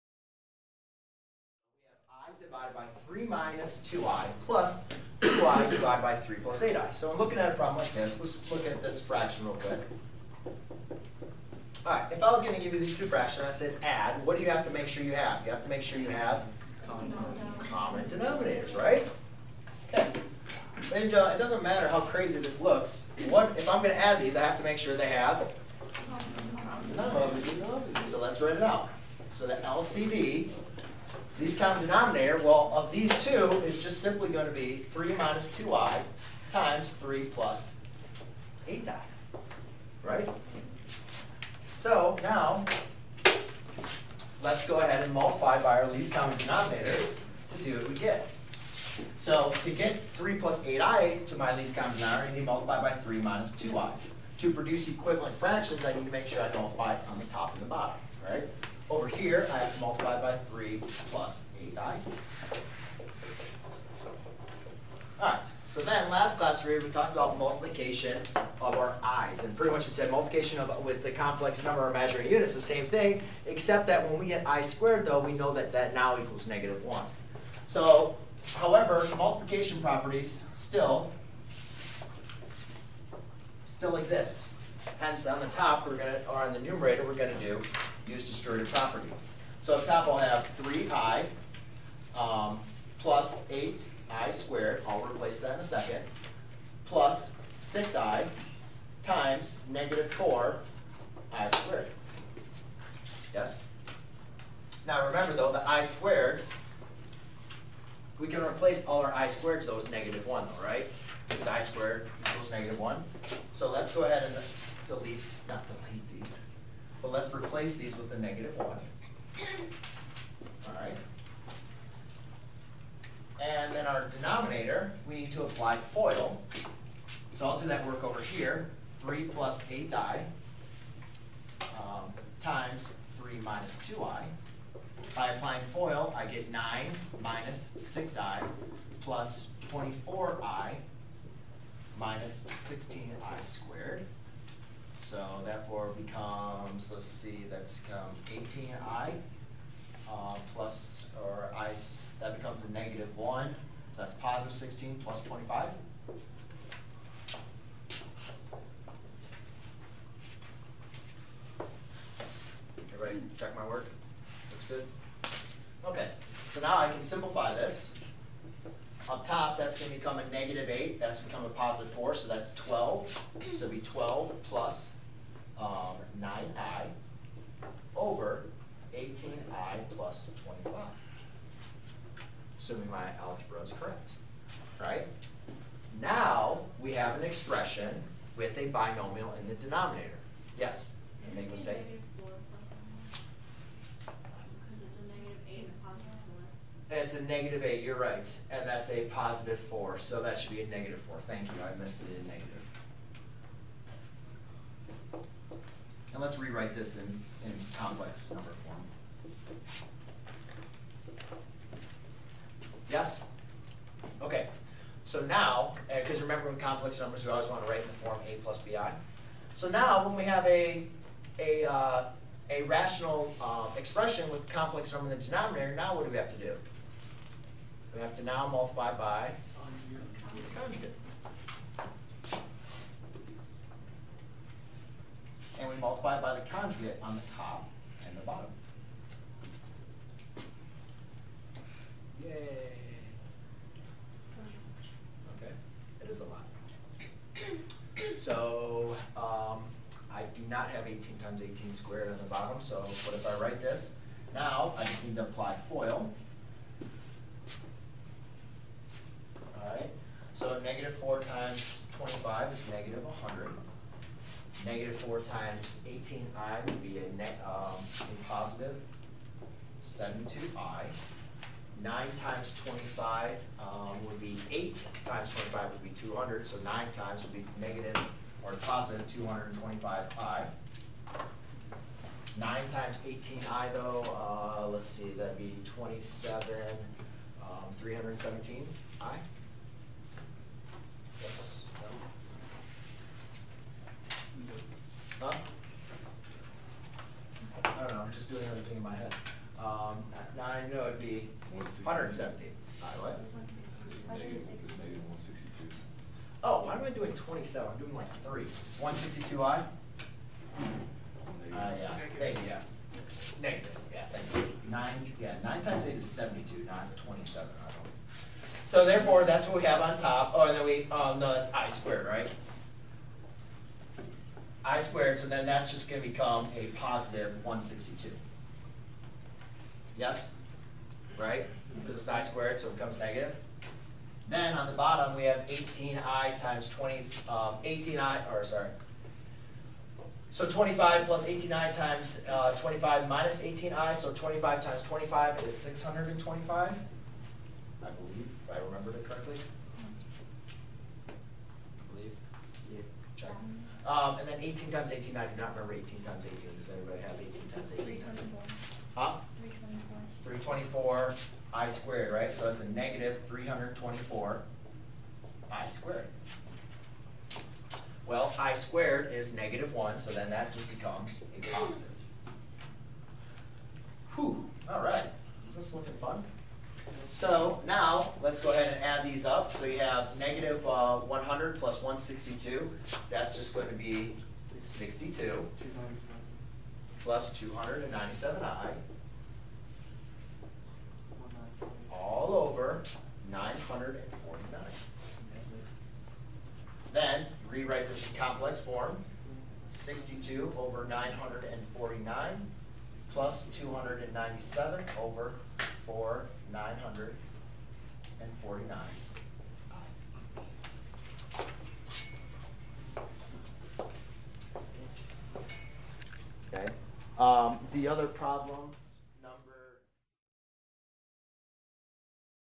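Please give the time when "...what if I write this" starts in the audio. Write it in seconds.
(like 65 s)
252 s.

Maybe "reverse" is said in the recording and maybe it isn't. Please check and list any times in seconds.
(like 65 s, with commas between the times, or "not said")
not said.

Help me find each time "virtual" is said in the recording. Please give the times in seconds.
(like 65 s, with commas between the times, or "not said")
not said.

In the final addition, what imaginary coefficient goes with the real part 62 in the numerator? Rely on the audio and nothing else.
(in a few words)
297.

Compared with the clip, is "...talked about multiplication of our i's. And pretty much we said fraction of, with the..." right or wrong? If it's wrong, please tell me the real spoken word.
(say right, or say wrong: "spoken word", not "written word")
wrong: "multiplication", not "fraction".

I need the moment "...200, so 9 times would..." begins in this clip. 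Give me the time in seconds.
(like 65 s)
275 s.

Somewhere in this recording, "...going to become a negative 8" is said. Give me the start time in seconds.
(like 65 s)
169 s.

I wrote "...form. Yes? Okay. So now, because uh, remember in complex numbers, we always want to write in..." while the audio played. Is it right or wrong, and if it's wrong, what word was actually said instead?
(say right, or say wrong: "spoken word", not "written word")
right.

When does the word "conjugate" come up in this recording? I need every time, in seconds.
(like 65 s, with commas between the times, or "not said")
230 s, 236 s.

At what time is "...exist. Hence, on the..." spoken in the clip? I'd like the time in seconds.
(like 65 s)
83 s.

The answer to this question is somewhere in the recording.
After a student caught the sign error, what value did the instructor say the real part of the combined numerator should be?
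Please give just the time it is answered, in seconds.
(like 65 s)
200 s.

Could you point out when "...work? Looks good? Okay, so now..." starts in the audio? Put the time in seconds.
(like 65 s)
163 s.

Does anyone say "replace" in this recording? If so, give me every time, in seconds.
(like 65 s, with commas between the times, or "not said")
95 s, 108 s, 117 s.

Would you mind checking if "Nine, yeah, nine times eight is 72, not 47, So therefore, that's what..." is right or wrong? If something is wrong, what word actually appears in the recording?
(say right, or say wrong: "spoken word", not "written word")
wrong: "27", not "47".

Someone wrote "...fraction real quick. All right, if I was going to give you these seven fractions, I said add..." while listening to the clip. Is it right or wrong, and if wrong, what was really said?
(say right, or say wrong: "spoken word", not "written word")
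wrong: "two", not "seven".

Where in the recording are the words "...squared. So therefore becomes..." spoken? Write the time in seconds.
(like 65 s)
143 s.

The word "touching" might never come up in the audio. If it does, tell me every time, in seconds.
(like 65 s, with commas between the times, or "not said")
not said.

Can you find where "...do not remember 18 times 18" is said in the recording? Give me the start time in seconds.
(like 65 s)
355 s.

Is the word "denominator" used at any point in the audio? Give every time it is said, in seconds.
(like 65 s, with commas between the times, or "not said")
18 s, 27 s, 31 s, 46 s, 51 s, 124 s, 189 s, 225 s.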